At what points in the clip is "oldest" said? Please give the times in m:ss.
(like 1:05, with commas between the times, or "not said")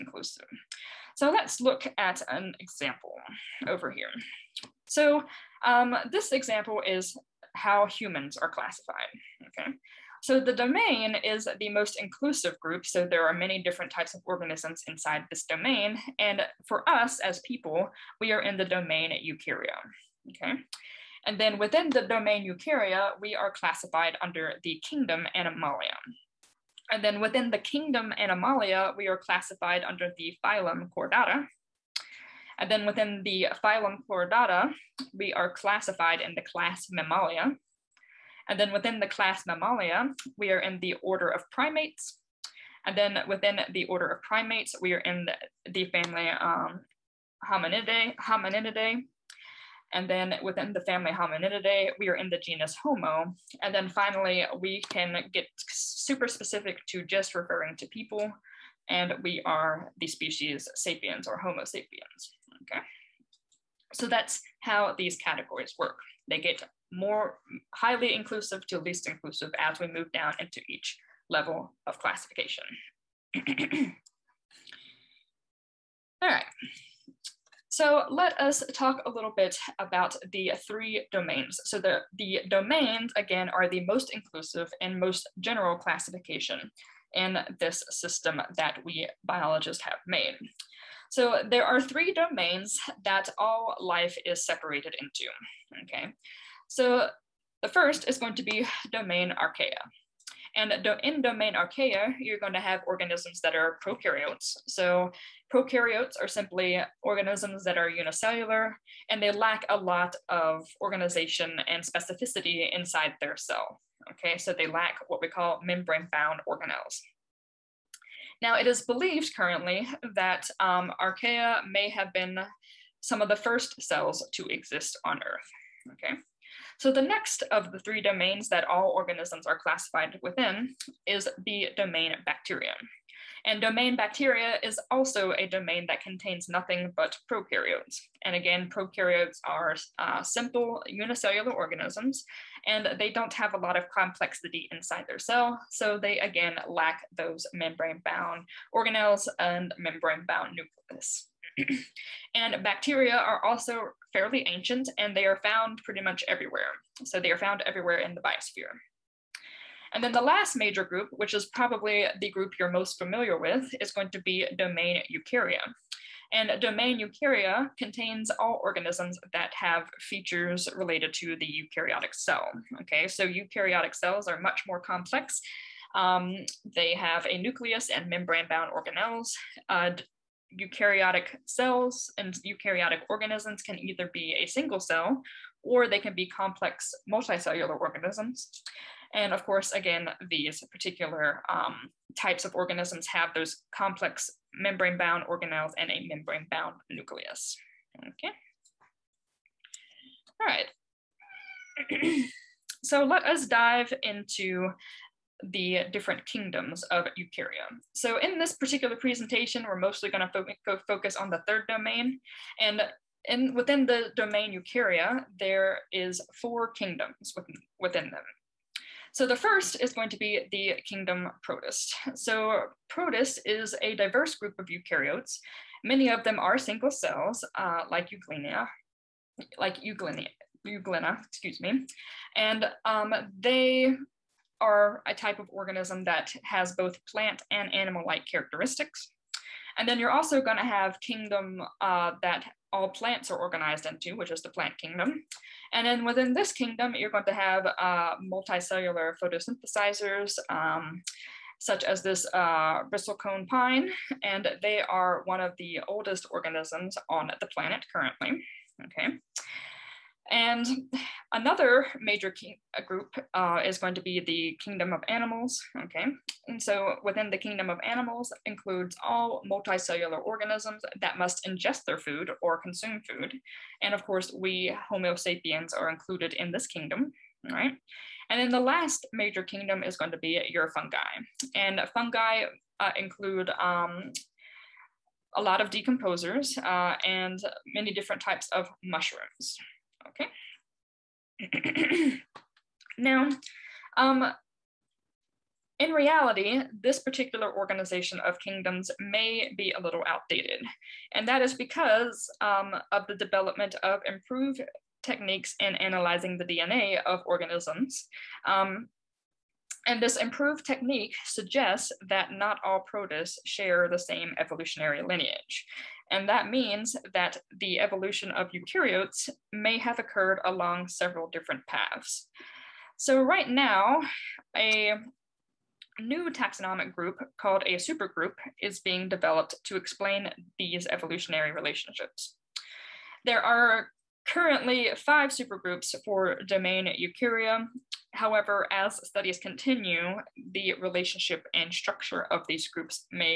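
4:15.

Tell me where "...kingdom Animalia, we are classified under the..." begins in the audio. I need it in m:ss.
0:27.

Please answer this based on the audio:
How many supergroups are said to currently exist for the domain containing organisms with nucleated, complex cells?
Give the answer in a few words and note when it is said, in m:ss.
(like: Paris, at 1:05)
5, at 5:34.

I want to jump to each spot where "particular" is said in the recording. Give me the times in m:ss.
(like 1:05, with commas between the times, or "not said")
3:10, 3:28, 4:56.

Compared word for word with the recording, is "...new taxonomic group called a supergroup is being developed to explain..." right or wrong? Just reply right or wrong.
right.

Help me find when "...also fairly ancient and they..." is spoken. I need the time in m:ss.
2:33.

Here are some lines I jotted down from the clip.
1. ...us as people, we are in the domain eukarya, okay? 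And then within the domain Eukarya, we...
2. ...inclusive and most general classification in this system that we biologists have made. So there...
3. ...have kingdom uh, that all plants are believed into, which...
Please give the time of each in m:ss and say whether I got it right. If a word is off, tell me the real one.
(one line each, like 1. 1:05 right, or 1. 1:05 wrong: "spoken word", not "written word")
1. 0:16 right
2. 1:24 right
3. 4:00 wrong: "organized", not "believed".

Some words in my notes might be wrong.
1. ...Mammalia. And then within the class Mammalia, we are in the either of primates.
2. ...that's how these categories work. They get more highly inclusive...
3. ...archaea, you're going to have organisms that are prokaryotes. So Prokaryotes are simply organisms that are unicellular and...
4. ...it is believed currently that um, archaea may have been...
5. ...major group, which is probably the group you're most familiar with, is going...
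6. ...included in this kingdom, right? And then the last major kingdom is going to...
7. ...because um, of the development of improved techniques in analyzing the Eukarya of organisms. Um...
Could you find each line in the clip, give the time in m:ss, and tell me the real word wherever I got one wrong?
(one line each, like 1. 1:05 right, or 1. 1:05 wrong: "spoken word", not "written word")
1. 0:36 wrong: "order", not "either"
2. 1:04 right
3. 1:41 right
4. 1:58 right
5. 2:40 right
6. 4:35 right
7. 5:01 wrong: "DNA", not "Eukarya".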